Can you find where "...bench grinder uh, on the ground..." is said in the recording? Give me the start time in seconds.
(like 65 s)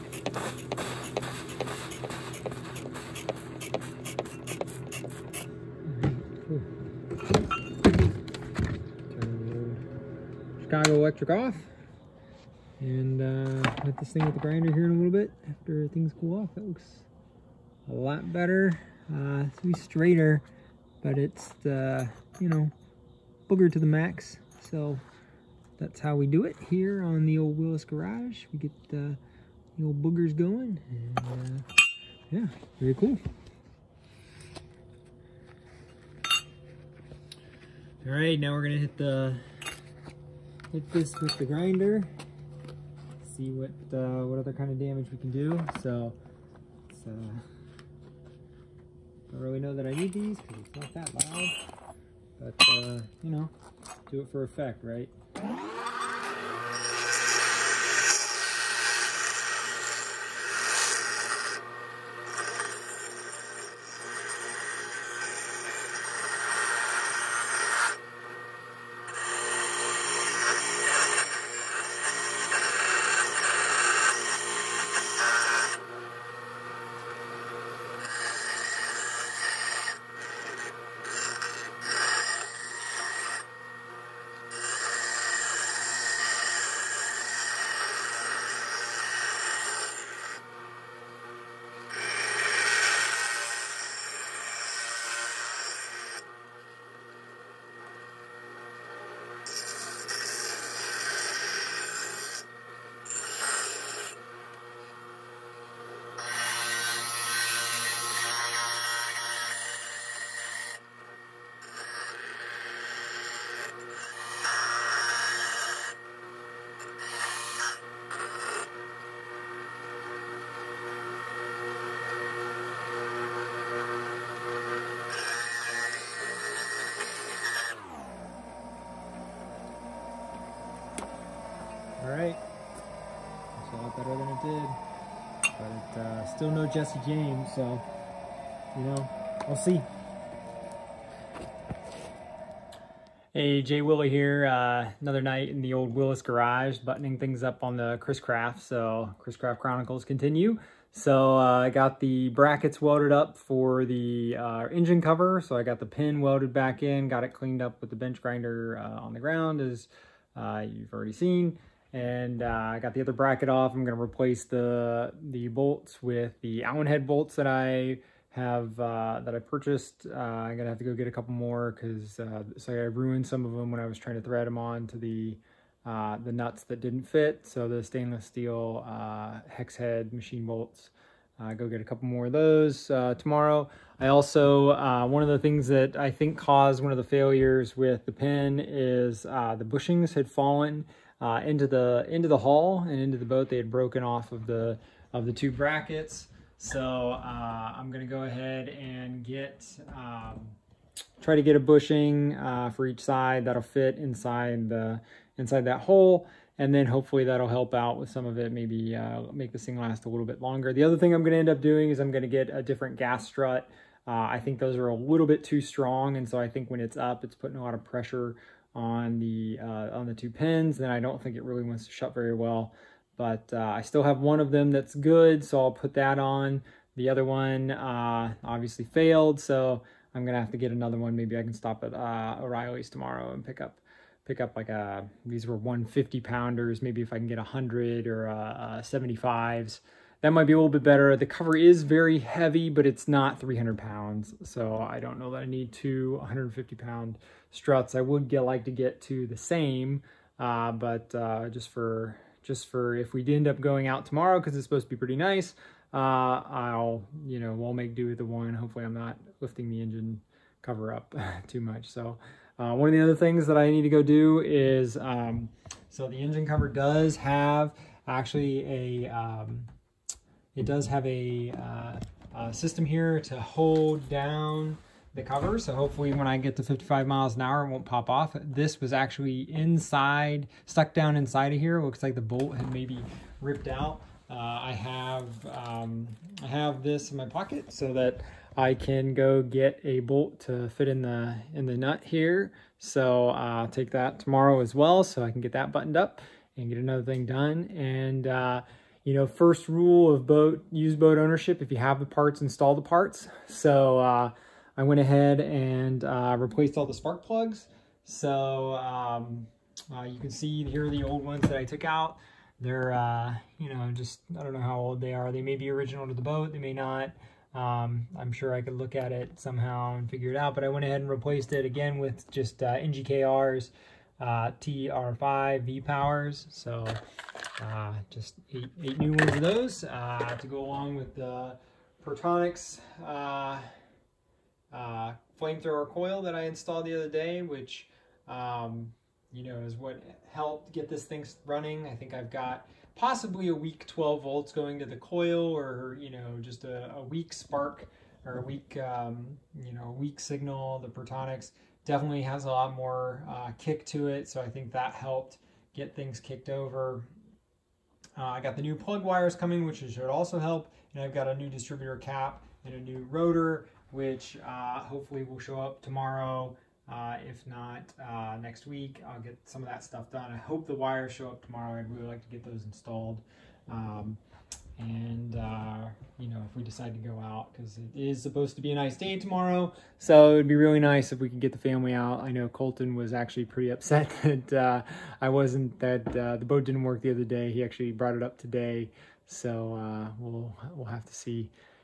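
157 s.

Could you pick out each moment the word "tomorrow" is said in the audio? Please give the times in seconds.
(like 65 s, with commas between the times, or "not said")
182 s, 232 s, 254 s, 294 s, 365 s, 371 s, 379 s.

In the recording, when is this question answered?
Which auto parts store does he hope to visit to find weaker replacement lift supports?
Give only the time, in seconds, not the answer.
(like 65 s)
232 s.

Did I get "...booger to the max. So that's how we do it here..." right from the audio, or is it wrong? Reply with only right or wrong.
right.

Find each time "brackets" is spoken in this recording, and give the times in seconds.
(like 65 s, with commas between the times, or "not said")
152 s, 163 s, 195 s.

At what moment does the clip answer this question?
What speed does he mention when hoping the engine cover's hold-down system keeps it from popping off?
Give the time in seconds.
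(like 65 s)
276 s.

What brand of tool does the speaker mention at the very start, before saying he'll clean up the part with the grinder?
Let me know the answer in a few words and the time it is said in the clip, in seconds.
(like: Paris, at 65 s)
Chicago Electric, at 10 s.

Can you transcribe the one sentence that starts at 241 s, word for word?
The cover is very heavy, but it's not 300 pounds.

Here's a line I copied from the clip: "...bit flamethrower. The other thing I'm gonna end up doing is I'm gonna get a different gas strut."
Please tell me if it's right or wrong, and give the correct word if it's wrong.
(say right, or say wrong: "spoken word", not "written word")
wrong: "longer", not "flamethrower".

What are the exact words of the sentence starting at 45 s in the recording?
So uh, don't really know that I need these because it's not that loud.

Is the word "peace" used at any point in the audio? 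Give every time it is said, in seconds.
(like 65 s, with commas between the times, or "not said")
not said.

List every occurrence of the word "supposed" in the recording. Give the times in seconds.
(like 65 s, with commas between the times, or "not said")
254 s, 378 s.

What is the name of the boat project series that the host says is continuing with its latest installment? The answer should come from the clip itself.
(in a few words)
Chris Craft Chronicles.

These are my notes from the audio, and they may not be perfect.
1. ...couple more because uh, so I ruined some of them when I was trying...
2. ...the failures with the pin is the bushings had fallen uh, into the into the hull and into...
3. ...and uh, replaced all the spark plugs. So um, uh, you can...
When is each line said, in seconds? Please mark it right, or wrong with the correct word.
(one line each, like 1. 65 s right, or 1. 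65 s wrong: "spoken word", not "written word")
1. 171 s right
2. 186 s right
3. 305 s right.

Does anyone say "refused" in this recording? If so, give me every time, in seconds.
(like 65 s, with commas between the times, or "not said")
not said.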